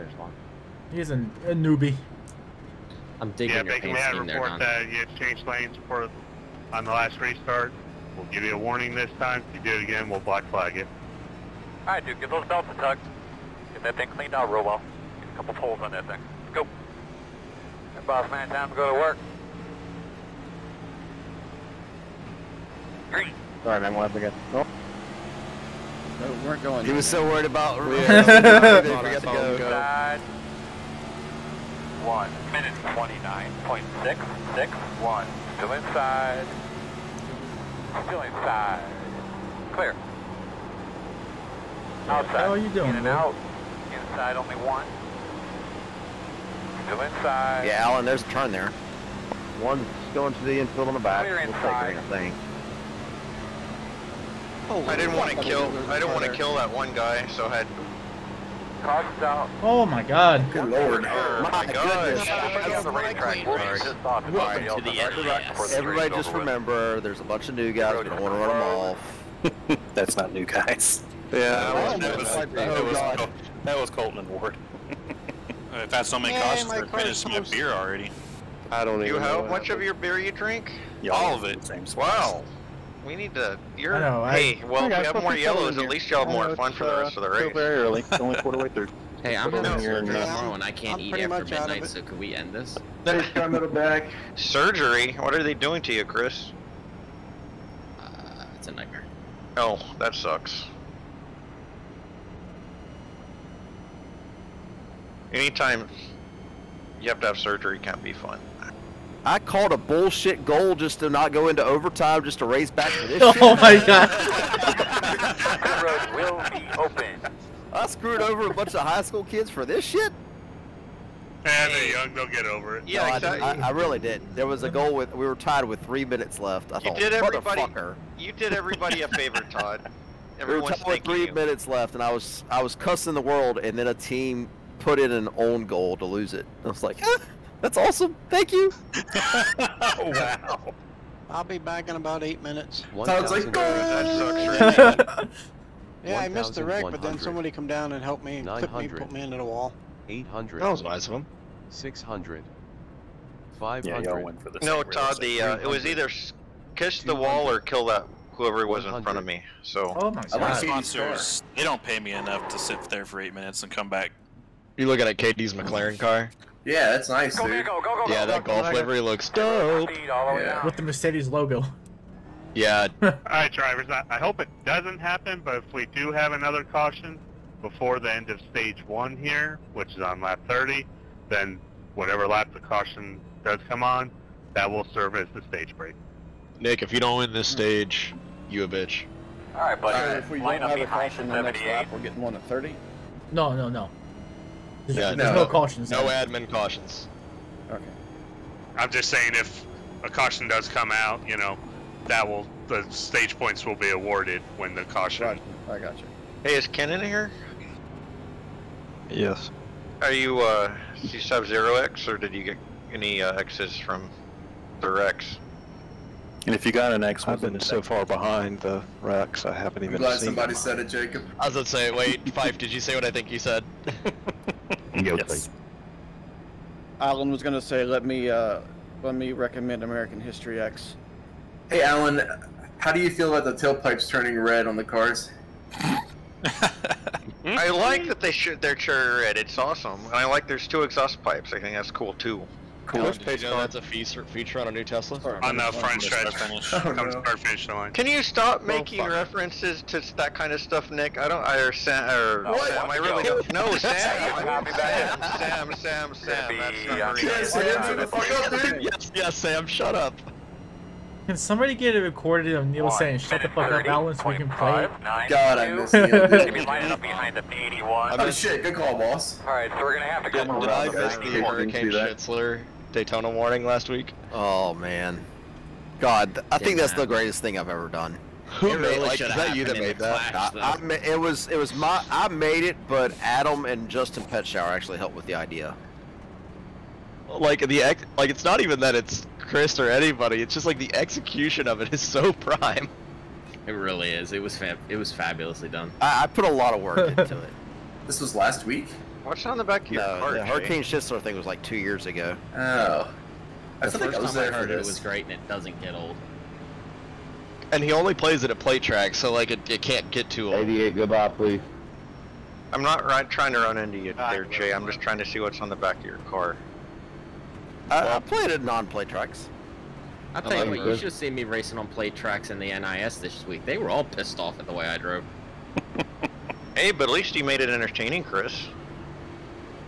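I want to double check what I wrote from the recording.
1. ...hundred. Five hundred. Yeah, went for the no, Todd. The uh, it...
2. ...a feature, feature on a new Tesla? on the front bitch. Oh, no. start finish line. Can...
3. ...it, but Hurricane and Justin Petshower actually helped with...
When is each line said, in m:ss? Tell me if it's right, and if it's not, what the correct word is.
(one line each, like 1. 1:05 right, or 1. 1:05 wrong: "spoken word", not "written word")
1. 2:31 right
2. 4:03 wrong: "stretch", not "bitch"
3. 4:42 wrong: "Adam", not "Hurricane".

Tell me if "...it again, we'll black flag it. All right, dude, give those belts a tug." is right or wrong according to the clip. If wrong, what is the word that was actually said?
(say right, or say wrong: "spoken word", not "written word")
right.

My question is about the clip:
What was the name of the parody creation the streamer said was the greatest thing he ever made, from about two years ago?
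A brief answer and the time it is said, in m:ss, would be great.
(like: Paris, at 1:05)
Hurricane Schnitzler, at 4:31.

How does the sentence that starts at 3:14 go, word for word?
There's, yeah, there's no, no, cautions.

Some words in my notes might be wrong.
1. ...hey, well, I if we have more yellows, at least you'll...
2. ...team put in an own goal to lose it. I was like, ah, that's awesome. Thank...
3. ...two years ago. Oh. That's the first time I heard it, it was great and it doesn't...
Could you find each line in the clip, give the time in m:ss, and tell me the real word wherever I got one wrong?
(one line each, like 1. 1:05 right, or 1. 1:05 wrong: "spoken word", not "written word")
1. 1:24 right
2. 2:13 right
3. 5:01 right.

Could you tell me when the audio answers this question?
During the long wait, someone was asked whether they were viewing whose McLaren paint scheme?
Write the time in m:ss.
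2:45.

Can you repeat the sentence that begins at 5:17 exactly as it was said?
I, I played at non-play tracks.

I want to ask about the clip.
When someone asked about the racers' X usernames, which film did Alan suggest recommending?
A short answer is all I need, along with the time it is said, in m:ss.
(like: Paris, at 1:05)
American History X, at 3:49.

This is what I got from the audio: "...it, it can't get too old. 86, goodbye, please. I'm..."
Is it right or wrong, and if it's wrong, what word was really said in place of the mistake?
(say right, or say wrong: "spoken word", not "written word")
wrong: "88", not "86".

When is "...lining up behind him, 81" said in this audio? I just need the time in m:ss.
4:26.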